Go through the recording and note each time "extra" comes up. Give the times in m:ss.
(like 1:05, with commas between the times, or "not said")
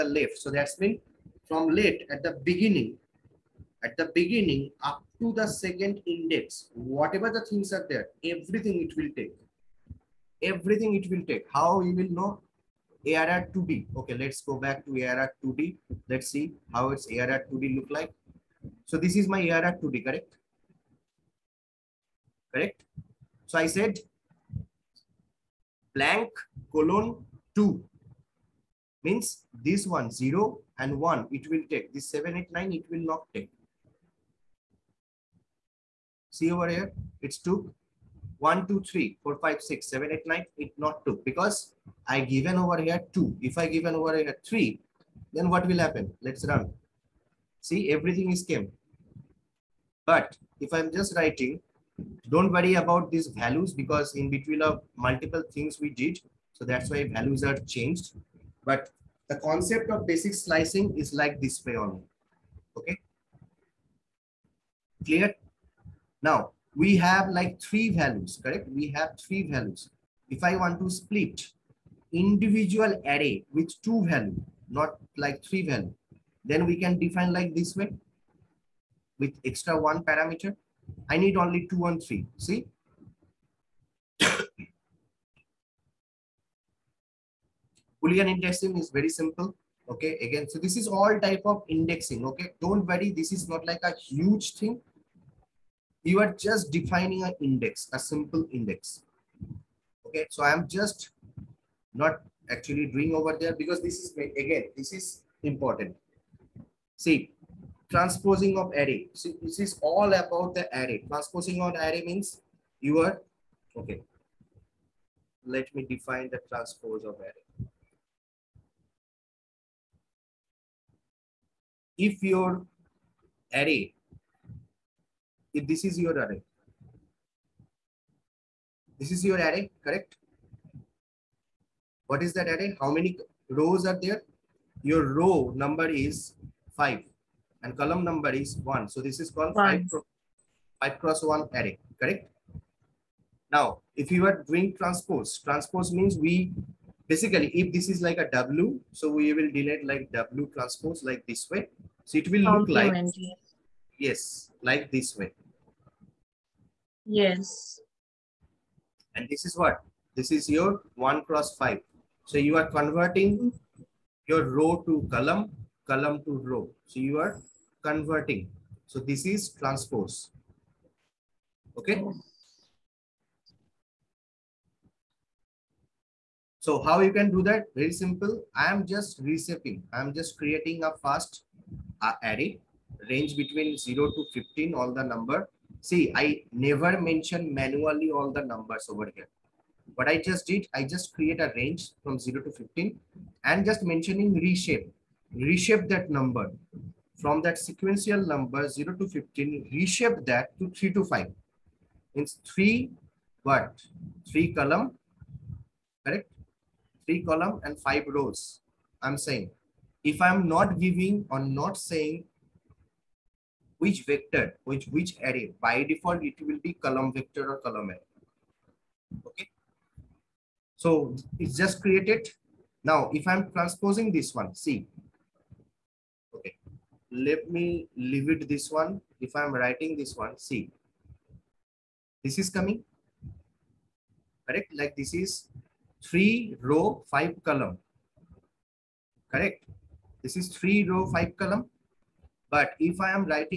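1:19.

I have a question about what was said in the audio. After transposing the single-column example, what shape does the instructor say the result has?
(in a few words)
1 cross 5.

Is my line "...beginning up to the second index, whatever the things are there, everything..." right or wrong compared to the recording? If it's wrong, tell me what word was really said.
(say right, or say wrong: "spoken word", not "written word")
right.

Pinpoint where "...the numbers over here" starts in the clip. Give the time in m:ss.
3:08.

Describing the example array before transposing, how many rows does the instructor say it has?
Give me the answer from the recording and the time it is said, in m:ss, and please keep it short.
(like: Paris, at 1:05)
5, at 2:15.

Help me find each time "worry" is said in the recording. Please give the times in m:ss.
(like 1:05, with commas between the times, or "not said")
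0:52, 1:32.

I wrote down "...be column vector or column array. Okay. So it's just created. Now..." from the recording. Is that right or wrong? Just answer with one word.
right.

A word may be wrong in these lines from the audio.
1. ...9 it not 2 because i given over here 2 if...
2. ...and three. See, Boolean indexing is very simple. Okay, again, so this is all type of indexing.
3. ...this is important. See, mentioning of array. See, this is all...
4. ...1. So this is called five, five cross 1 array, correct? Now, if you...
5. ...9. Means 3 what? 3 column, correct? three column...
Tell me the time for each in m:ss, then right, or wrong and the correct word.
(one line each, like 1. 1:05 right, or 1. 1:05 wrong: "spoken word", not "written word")
1. 0:40 right
2. 1:21 right
3. 1:44 wrong: "transposing", not "mentioning"
4. 2:18 right
5. 3:21 wrong: "5", not "9".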